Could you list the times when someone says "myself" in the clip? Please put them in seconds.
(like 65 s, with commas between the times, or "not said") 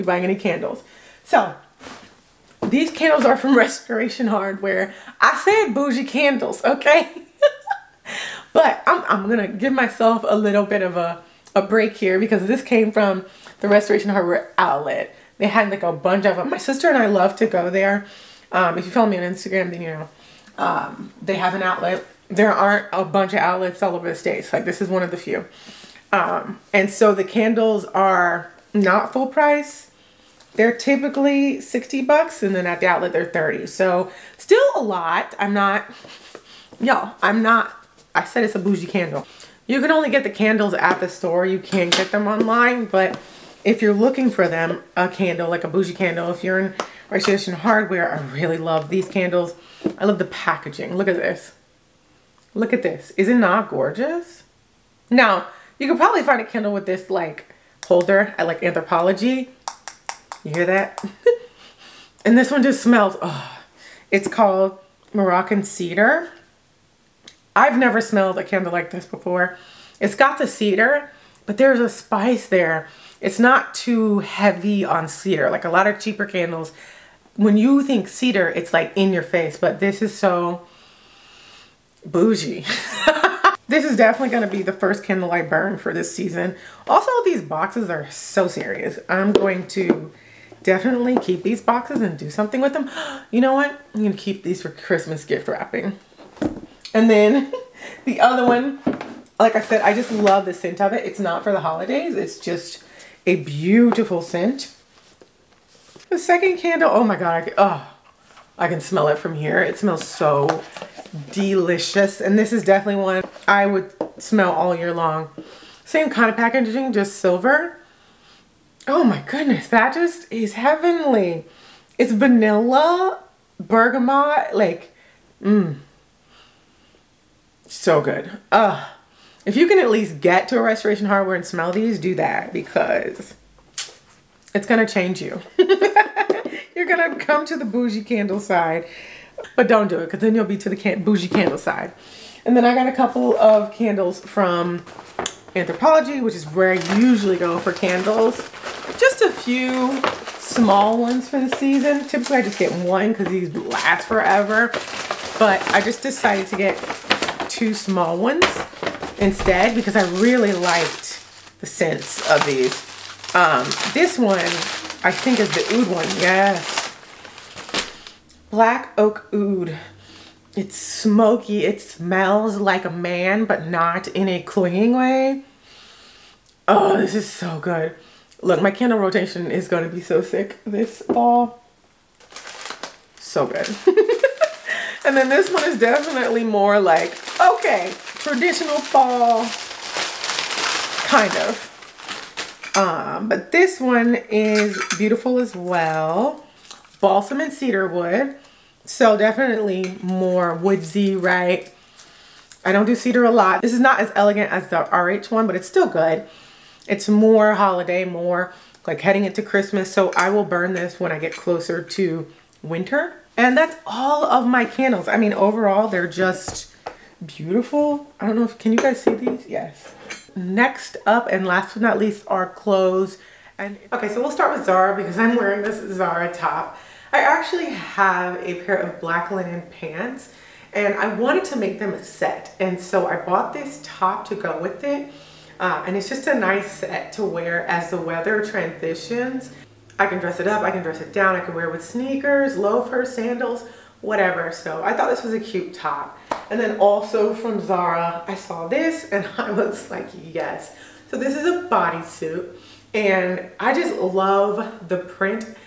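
9 s.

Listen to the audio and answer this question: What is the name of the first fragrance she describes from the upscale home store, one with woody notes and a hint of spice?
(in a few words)
Moroccan Cedar.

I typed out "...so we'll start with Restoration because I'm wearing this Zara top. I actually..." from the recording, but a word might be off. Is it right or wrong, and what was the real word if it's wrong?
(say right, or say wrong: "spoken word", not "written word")
wrong: "Zara", not "Restoration".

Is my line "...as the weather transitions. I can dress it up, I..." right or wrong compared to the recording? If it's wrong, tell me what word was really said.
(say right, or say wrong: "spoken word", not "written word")
right.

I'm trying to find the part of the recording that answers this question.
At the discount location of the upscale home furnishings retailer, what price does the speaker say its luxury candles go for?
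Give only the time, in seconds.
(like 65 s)
33 s.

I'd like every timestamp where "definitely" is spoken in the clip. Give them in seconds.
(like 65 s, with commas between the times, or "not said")
83 s, 90 s, 112 s, 185 s, 199 s.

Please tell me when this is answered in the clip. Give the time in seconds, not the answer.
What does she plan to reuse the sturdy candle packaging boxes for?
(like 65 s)
94 s.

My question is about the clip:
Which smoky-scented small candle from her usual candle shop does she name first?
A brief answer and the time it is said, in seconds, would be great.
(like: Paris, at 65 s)
Black oak oud, at 168 s.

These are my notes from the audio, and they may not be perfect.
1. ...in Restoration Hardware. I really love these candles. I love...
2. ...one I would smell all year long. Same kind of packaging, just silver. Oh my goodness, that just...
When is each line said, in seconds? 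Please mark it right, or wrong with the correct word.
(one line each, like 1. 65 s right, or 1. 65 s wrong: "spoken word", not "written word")
1. 46 s right
2. 113 s right.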